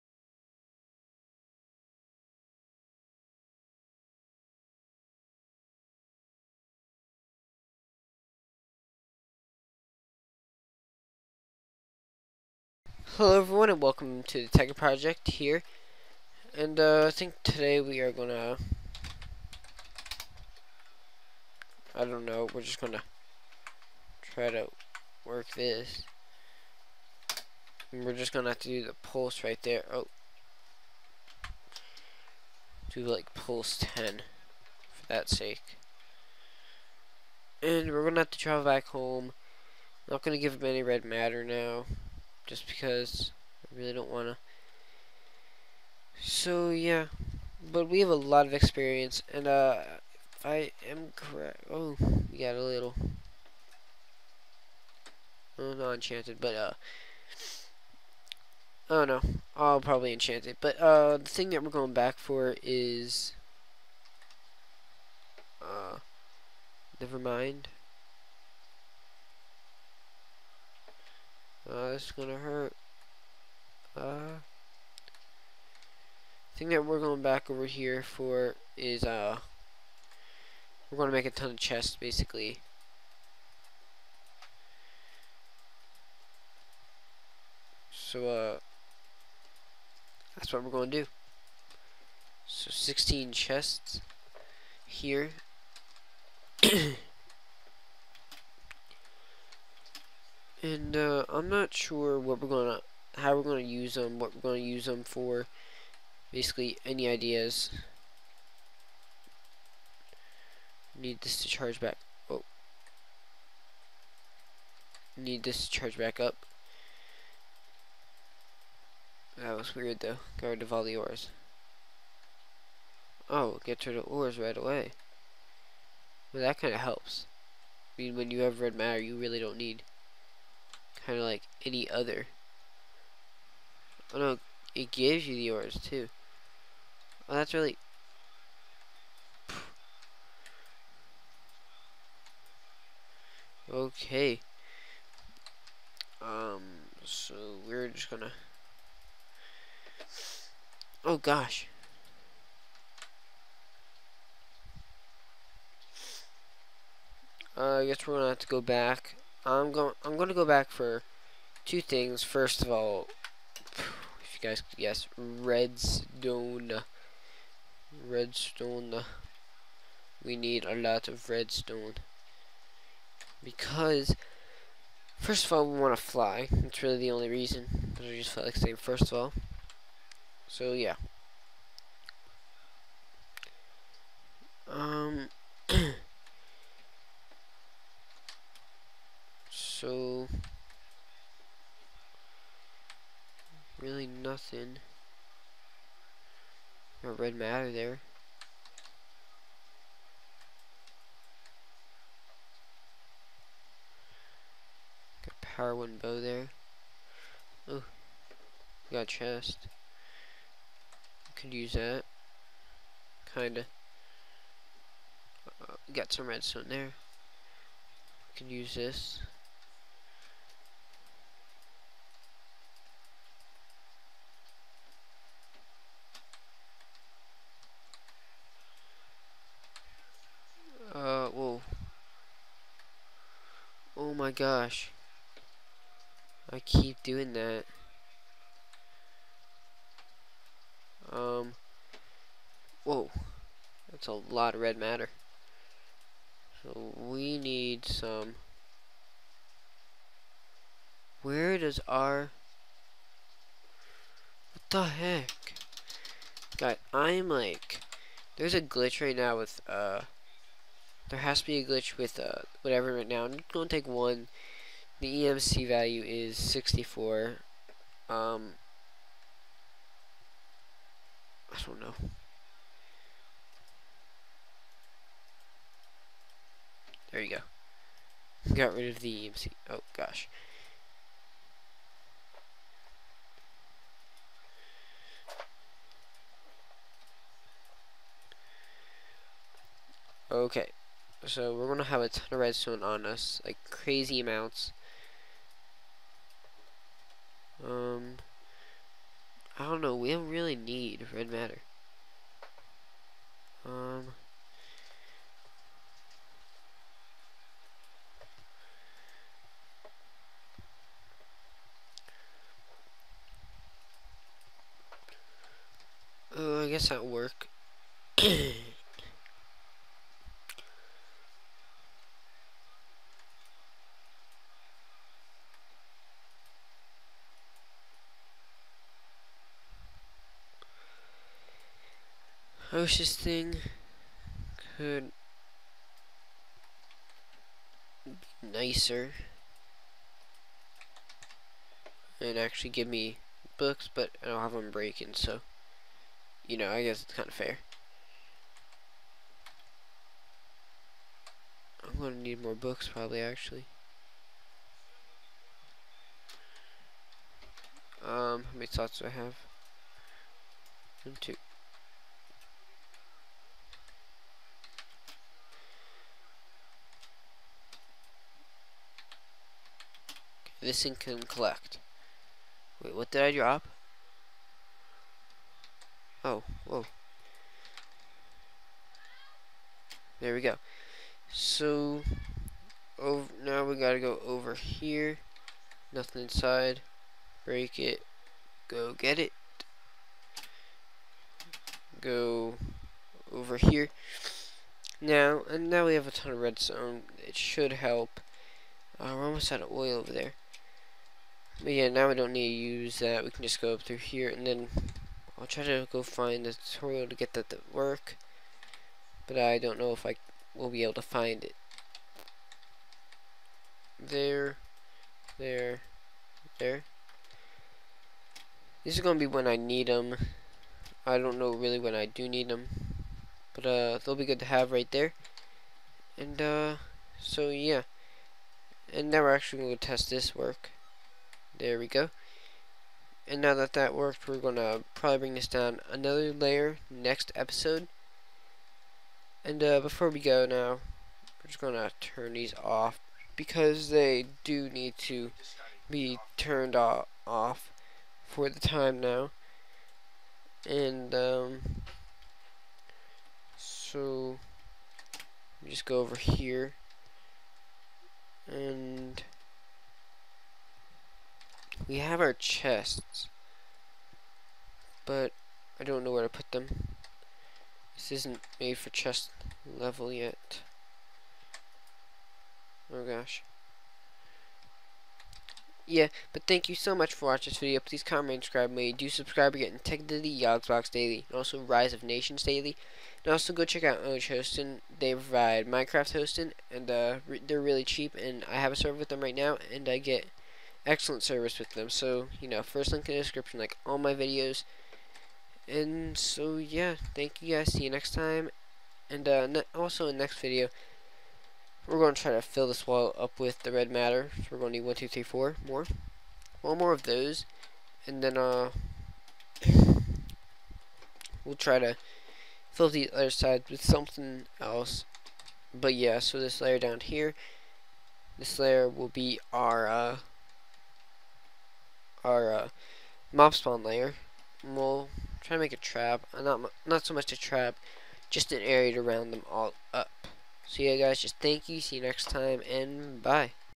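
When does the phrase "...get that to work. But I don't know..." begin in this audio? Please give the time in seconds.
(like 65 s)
407 s.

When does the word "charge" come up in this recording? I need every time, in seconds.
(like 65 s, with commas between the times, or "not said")
111 s, 115 s.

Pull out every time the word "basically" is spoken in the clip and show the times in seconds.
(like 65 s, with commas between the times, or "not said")
81 s, 106 s.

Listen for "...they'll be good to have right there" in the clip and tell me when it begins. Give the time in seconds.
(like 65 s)
423 s.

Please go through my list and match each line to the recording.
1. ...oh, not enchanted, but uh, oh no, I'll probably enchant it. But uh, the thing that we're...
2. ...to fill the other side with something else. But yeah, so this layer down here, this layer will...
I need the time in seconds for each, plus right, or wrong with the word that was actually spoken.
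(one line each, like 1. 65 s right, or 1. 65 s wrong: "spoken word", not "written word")
1. 55 s right
2. 511 s right.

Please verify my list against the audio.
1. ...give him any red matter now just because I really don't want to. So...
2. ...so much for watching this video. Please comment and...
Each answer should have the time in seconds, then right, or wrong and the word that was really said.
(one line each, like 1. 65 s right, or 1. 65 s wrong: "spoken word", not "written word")
1. 40 s right
2. 476 s right.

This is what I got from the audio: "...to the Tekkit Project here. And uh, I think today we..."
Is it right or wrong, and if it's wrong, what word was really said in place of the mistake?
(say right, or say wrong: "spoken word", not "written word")
right.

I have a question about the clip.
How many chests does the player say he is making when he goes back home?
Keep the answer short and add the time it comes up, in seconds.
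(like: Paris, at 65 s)
16, at 92 s.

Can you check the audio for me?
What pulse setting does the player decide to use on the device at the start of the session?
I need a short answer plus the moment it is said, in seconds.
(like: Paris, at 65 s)
10, at 33 s.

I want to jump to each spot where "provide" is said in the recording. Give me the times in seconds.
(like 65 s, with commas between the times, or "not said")
485 s.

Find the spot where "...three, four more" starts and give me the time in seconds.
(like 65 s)
505 s.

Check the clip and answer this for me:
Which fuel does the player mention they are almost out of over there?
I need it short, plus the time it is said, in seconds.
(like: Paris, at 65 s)
Oil, at 399 s.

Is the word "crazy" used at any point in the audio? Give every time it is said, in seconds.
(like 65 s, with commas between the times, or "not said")
293 s.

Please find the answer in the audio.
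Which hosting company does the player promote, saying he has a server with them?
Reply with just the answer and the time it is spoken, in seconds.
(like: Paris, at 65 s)
Ownage Hosting, at 484 s.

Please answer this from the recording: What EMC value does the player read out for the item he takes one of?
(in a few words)
64.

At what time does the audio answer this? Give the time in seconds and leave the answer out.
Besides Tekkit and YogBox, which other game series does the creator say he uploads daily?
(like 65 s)
481 s.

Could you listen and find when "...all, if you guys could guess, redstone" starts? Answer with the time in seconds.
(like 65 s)
162 s.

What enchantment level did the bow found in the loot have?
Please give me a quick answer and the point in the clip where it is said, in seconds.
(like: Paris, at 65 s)
Power 1, at 205 s.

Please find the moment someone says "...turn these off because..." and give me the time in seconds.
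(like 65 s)
441 s.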